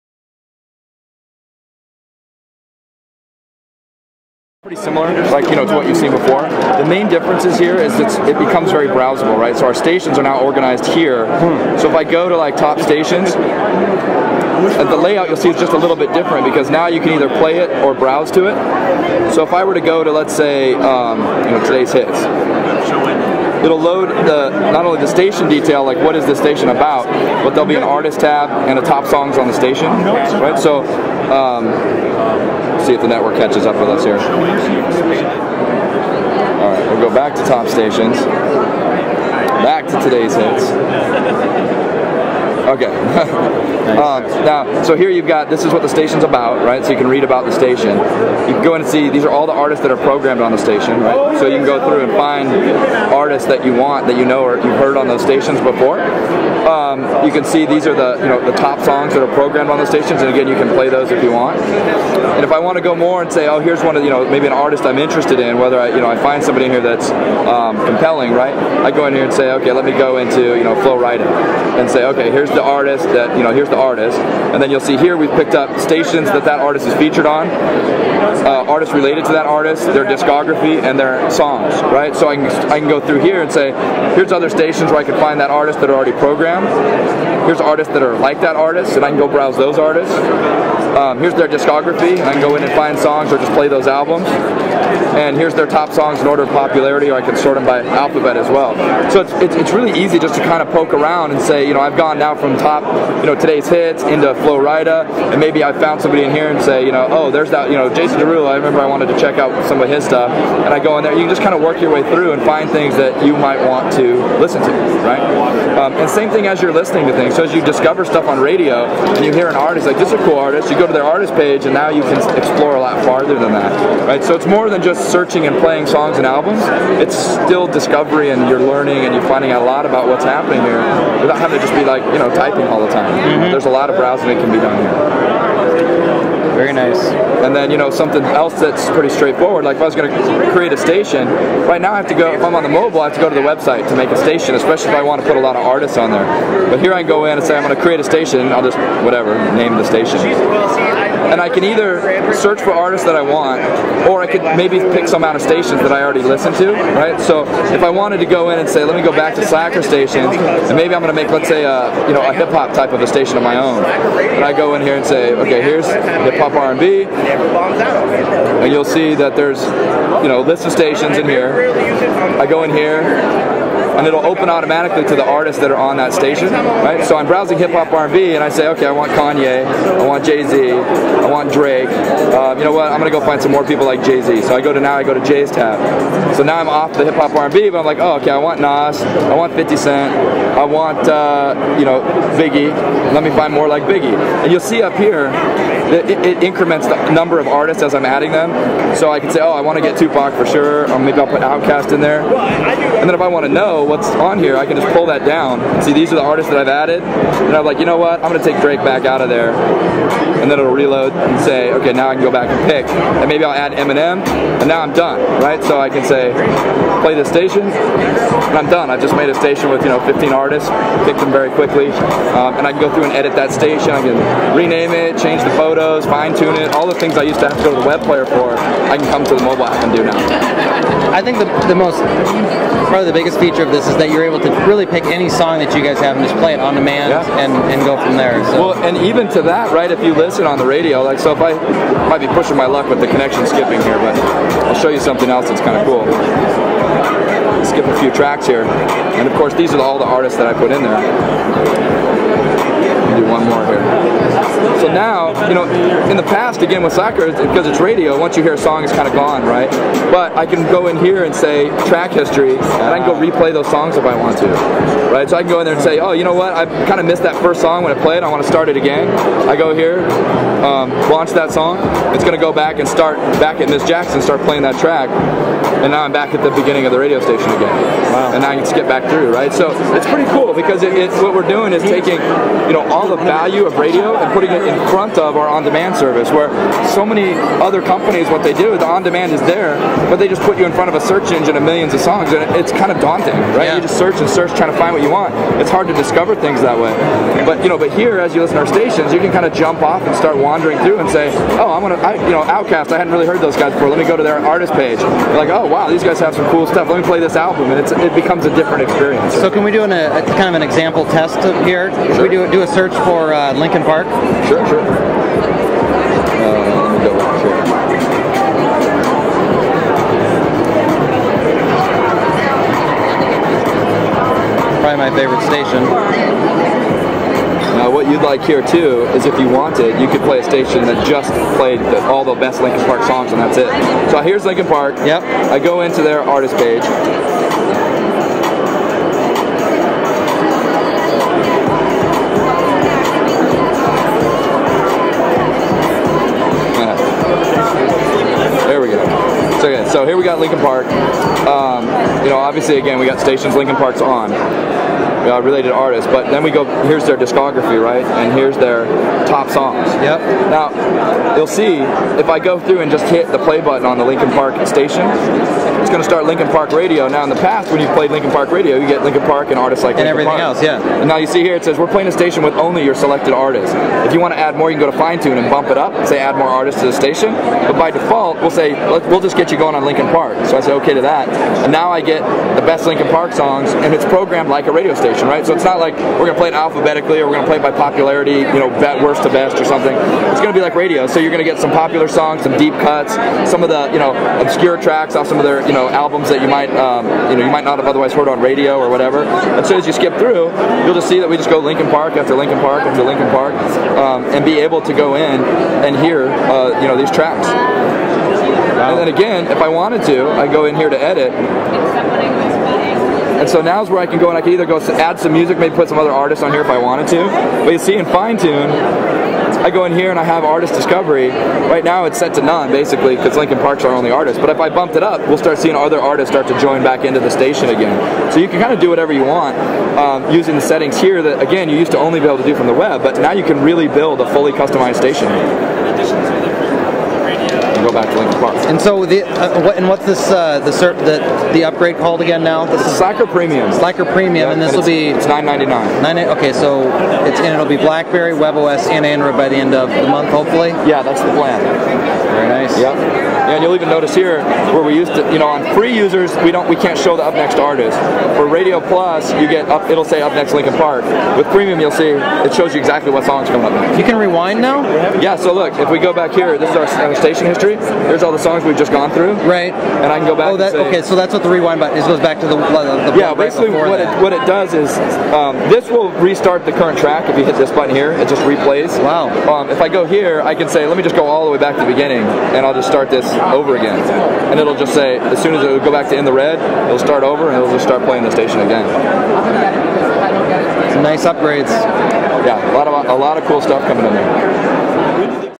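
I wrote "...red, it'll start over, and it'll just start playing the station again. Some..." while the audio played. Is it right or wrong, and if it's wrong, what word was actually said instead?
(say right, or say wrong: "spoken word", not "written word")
right.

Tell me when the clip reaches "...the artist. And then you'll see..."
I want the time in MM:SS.
01:13.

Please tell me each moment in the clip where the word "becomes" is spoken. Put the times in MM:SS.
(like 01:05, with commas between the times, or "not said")
00:08, 05:08.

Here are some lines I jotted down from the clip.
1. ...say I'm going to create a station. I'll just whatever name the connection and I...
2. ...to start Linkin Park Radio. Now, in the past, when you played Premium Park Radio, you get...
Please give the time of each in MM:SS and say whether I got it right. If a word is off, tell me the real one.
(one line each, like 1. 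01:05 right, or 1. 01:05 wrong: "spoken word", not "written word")
1. 02:27 wrong: "station", not "connection"
2. 06:06 wrong: "Linkin", not "Premium".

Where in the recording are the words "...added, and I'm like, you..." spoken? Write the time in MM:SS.
03:26.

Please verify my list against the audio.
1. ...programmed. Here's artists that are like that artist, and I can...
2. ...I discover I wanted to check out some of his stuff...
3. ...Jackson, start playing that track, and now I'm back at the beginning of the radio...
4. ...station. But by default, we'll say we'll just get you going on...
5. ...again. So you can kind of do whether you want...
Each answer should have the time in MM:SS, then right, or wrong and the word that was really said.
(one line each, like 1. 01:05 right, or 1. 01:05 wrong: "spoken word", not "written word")
1. 01:26 right
2. 01:48 wrong: "remember", not "discover"
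3. 04:33 right
4. 06:16 right
5. 07:07 wrong: "whatever", not "whether".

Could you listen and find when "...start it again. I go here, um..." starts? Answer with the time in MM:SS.
04:28.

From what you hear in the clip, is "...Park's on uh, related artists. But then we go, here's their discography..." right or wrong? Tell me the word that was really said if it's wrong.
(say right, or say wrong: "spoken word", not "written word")
right.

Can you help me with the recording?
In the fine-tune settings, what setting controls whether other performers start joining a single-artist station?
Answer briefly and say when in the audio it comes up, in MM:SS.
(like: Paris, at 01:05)
Artist discovery, at 07:00.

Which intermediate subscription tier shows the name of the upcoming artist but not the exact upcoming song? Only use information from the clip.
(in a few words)
Radio Plus.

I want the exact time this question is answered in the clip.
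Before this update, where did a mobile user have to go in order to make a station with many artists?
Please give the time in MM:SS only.
02:23.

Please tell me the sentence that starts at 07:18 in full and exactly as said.
And so the uh, what, and what's this uh, the, cert, the the upgrade called again now?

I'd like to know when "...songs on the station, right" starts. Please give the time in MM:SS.
00:29.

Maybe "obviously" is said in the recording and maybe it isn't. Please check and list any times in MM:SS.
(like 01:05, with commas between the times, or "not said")
05:52.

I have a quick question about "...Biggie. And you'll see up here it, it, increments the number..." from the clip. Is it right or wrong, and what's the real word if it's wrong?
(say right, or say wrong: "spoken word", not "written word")
right.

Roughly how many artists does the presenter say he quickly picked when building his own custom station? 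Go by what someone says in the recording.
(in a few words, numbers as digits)
15.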